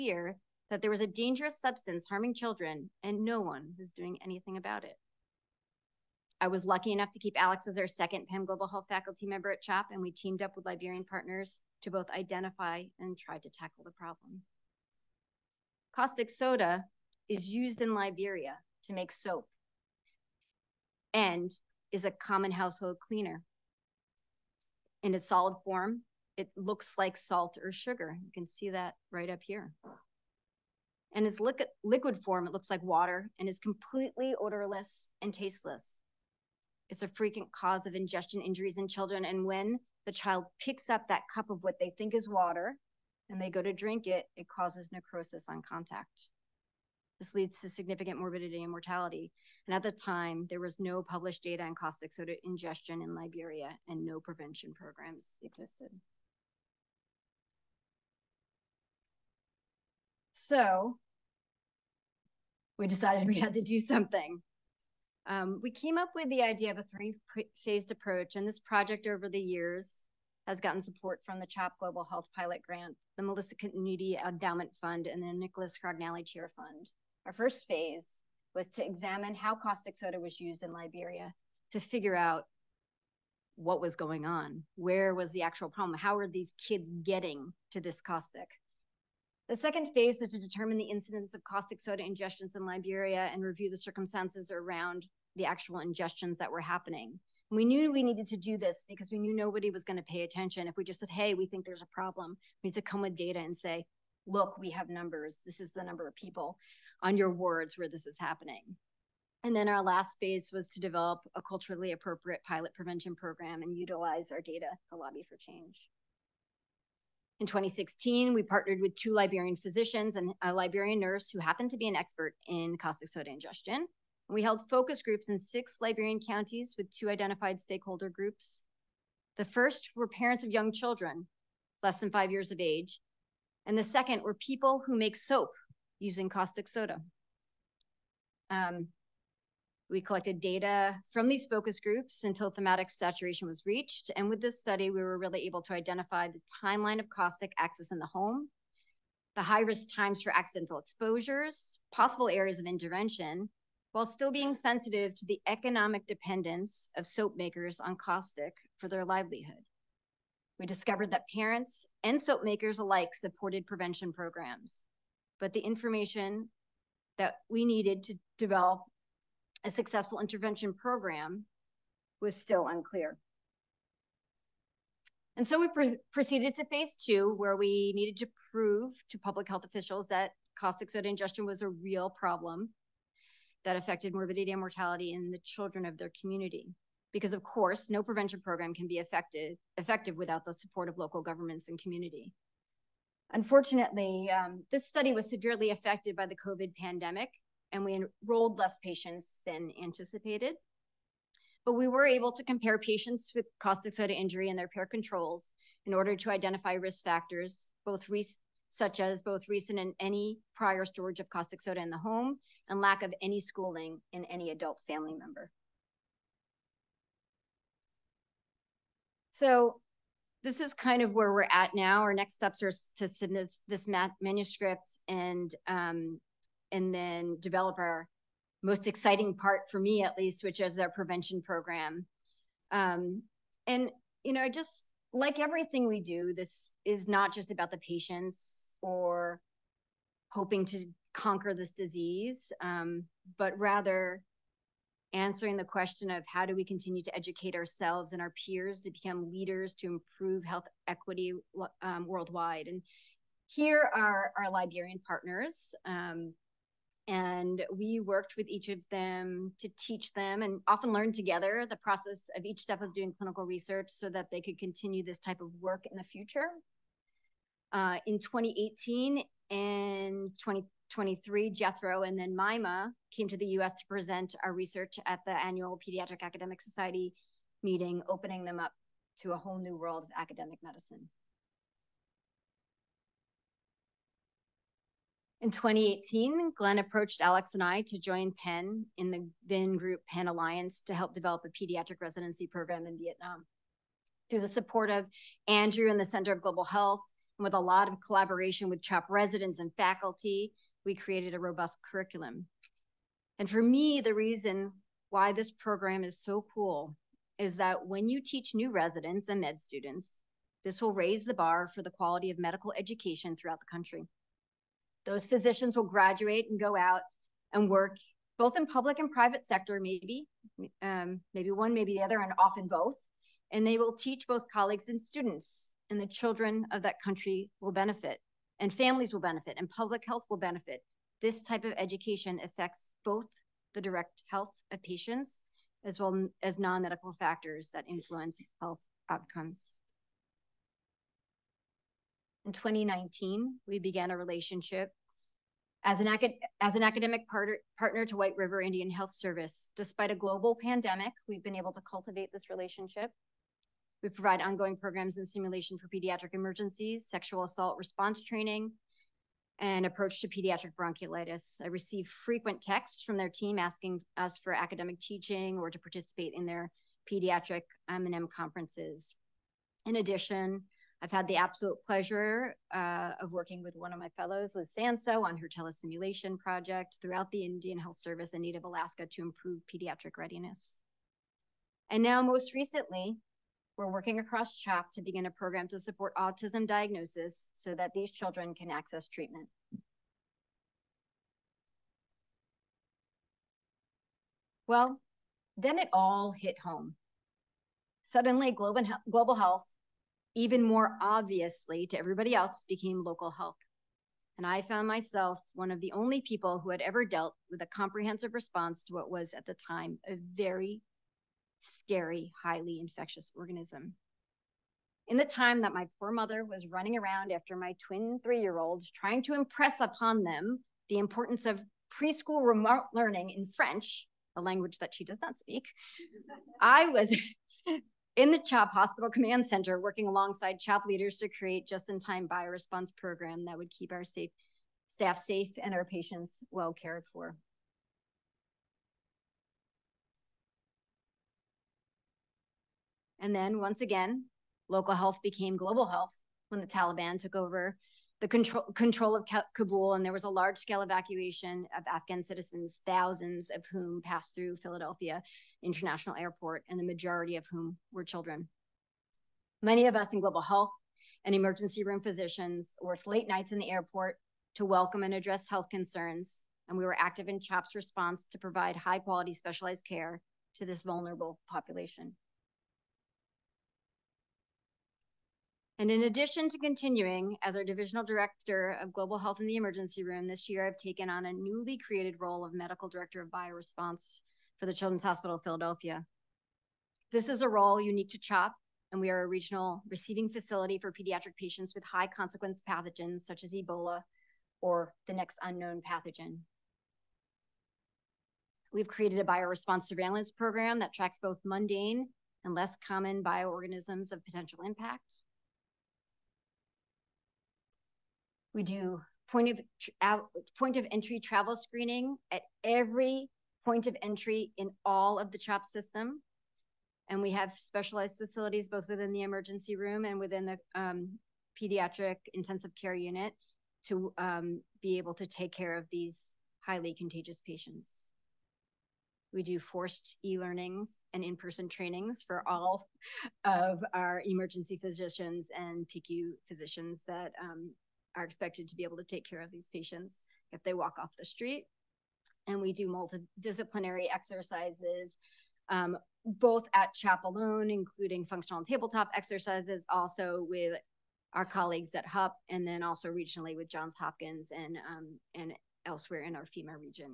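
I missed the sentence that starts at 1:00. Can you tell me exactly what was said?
So we decided we had to do something.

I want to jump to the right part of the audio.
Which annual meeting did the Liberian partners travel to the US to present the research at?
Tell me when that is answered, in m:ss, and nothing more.
4:35.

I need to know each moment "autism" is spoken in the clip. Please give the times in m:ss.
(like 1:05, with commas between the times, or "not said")
6:26.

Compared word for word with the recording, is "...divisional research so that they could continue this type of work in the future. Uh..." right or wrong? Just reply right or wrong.
wrong.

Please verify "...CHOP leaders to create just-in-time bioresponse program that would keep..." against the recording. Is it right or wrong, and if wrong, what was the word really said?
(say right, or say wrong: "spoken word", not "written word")
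right.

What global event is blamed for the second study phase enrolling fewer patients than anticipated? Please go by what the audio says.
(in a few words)
COVID pandemic.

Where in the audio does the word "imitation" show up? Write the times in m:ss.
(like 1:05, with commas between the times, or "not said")
not said.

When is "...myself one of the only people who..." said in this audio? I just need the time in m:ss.
6:44.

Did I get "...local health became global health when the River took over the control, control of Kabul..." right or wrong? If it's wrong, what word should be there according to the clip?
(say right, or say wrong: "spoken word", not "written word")
wrong: "Taliban", not "River".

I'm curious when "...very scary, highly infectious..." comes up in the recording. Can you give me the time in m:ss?
6:50.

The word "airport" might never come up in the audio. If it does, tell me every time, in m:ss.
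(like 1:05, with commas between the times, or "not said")
7:36, 7:43.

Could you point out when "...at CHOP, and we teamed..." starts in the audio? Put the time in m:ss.
0:09.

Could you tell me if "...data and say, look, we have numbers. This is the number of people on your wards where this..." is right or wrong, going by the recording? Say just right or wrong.
right.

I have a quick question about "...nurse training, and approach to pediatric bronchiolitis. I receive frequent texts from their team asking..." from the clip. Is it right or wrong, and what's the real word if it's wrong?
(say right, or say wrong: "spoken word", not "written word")
wrong: "response", not "nurse".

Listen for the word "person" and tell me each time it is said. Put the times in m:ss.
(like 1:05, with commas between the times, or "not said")
8:51.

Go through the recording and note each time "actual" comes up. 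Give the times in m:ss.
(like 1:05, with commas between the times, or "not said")
1:25, 1:35.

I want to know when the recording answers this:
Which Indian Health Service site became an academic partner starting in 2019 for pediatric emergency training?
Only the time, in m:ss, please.
5:48.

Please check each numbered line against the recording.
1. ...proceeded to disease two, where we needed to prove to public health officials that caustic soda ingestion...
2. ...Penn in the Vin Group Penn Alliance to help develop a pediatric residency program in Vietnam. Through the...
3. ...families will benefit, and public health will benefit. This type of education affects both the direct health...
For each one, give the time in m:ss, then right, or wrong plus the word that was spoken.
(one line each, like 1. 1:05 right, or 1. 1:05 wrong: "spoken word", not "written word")
1. 2:56 wrong: "phase", not "disease"
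2. 4:48 right
3. 5:28 right.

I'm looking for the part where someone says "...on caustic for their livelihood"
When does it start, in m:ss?
2:37.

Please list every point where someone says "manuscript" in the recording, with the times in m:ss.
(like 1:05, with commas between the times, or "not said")
3:44.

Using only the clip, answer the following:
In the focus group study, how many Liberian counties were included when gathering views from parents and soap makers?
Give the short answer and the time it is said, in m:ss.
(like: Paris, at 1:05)
6, at 2:05.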